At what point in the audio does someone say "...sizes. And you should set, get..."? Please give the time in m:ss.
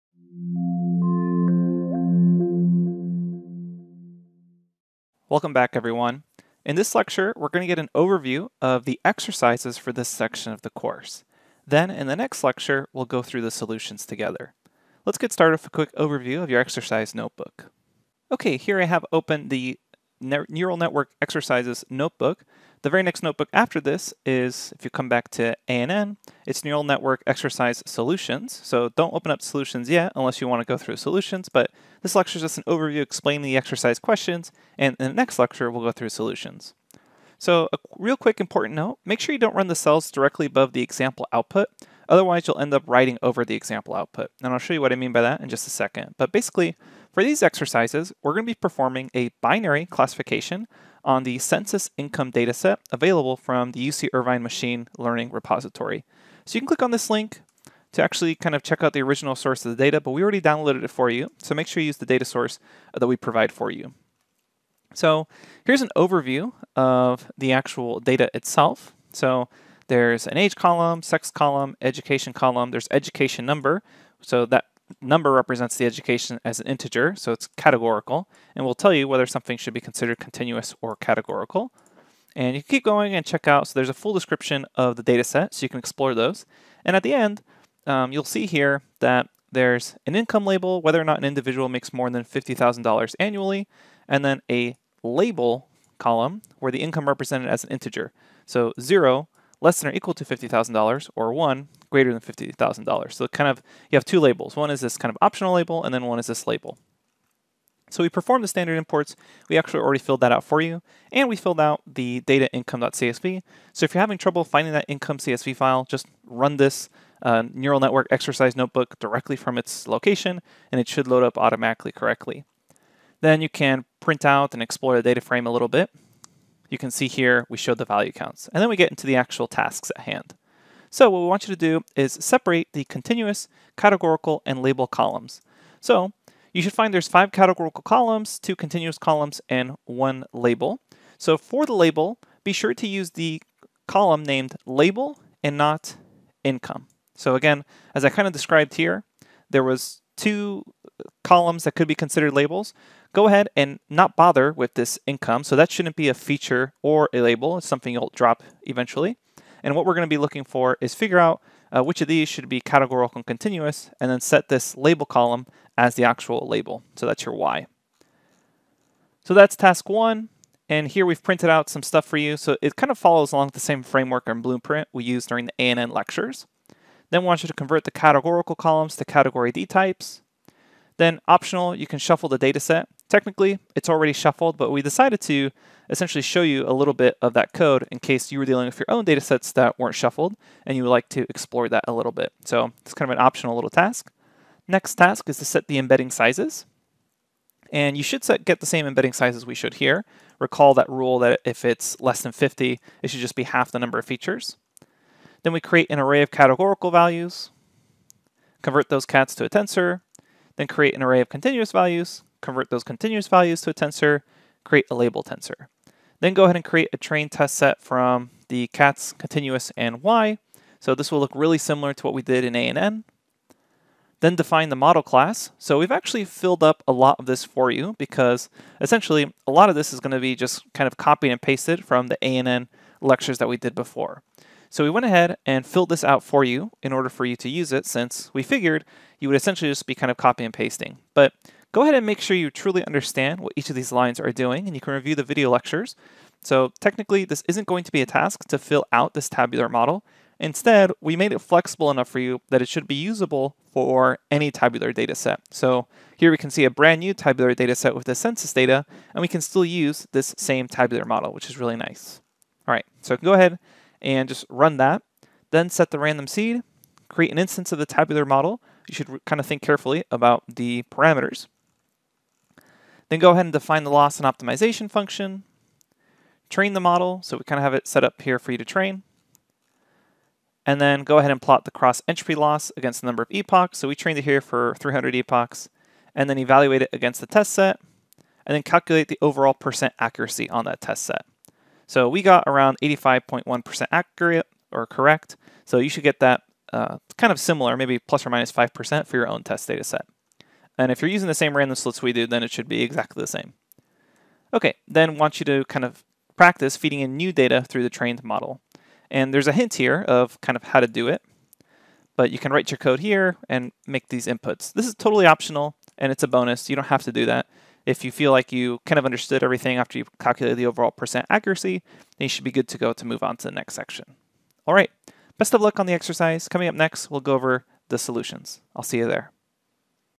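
3:16.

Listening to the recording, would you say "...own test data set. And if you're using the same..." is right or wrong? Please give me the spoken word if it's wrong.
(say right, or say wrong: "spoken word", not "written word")
right.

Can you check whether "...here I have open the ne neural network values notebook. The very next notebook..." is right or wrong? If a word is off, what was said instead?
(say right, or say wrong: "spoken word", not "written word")
wrong: "exercises", not "values".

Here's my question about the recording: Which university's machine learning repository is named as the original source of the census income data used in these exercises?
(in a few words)
UC Irvine.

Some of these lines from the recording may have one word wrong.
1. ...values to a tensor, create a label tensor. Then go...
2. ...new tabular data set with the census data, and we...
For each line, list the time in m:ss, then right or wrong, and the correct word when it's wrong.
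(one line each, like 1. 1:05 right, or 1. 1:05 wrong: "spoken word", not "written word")
1. 3:33 right
2. 4:17 right.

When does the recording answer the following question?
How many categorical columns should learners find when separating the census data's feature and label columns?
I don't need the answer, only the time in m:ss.
2:17.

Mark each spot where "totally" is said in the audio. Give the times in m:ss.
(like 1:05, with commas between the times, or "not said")
5:14.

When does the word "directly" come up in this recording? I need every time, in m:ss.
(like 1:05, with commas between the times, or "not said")
0:40, 1:58.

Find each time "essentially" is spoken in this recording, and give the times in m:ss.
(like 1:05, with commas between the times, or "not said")
3:05, 3:48, 3:59.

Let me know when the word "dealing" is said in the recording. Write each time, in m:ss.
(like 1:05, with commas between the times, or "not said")
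3:08.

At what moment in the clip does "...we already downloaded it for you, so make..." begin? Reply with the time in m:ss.
1:00.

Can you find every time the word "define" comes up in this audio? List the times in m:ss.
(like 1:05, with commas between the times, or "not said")
3:44, 4:33.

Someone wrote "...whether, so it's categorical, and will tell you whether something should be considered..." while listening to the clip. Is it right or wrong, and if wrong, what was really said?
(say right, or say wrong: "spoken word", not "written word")
wrong: "integer", not "whether".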